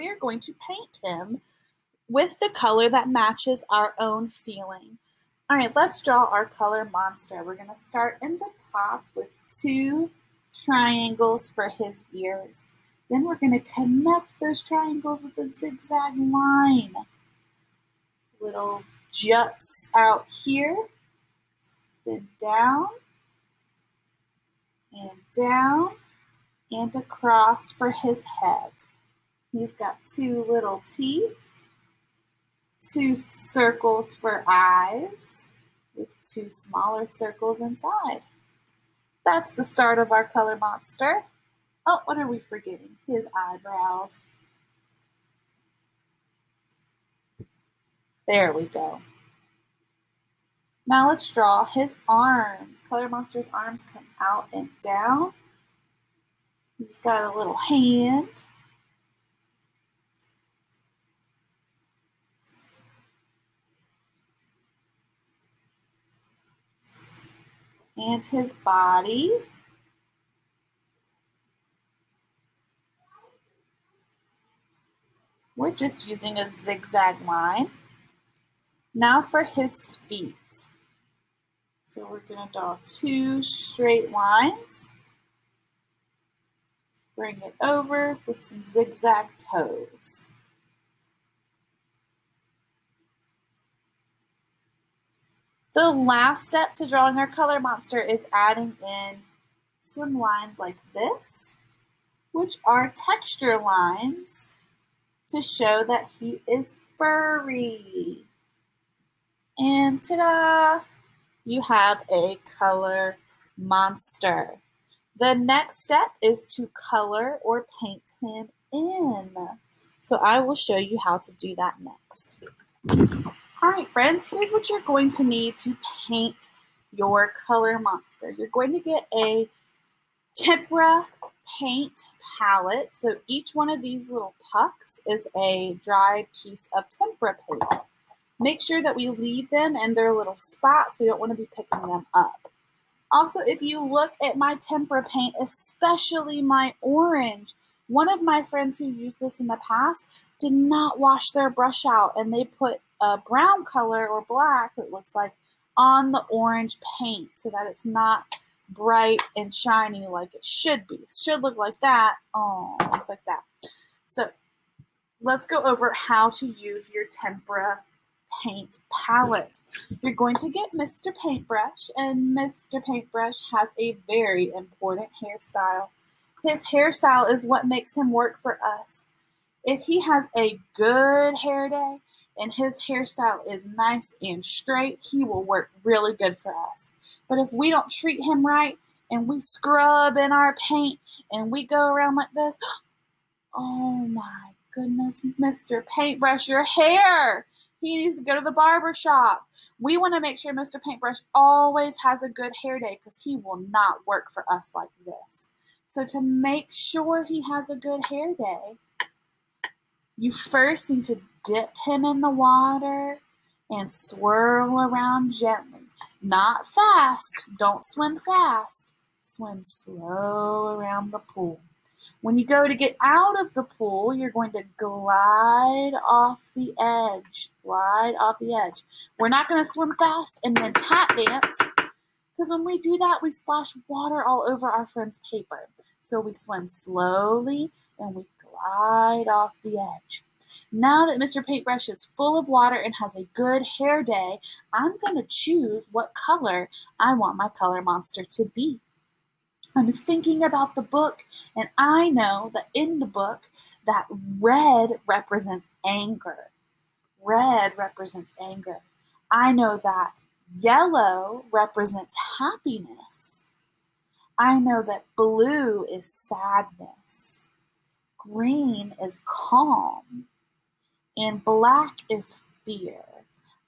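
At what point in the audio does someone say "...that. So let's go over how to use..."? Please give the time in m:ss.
2:43.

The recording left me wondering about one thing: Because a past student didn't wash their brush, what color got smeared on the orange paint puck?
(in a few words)
brown.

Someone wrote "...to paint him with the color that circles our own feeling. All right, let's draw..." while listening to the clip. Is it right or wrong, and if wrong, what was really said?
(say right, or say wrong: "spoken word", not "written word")
wrong: "matches", not "circles".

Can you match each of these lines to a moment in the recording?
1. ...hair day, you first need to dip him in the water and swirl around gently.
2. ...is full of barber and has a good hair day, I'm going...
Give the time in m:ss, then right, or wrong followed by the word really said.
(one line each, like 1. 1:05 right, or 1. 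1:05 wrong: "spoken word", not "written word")
1. 3:28 right
2. 4:01 wrong: "water", not "barber".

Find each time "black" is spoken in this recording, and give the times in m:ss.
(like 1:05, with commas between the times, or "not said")
2:34, 4:31.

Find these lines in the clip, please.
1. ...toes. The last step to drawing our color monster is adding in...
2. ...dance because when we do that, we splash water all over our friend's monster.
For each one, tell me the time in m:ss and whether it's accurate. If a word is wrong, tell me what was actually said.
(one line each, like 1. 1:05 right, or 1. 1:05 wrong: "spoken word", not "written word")
1. 1:29 right
2. 3:51 wrong: "paper", not "monster".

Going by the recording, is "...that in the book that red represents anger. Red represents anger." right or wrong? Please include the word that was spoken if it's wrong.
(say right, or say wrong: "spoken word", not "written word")
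right.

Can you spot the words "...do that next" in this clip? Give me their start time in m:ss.
2:01.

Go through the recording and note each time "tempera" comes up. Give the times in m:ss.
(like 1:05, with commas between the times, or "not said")
2:10, 2:16, 2:24, 2:47.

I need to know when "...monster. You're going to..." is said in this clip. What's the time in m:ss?
2:07.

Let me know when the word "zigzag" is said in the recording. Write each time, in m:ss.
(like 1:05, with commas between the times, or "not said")
0:15, 1:16, 1:28.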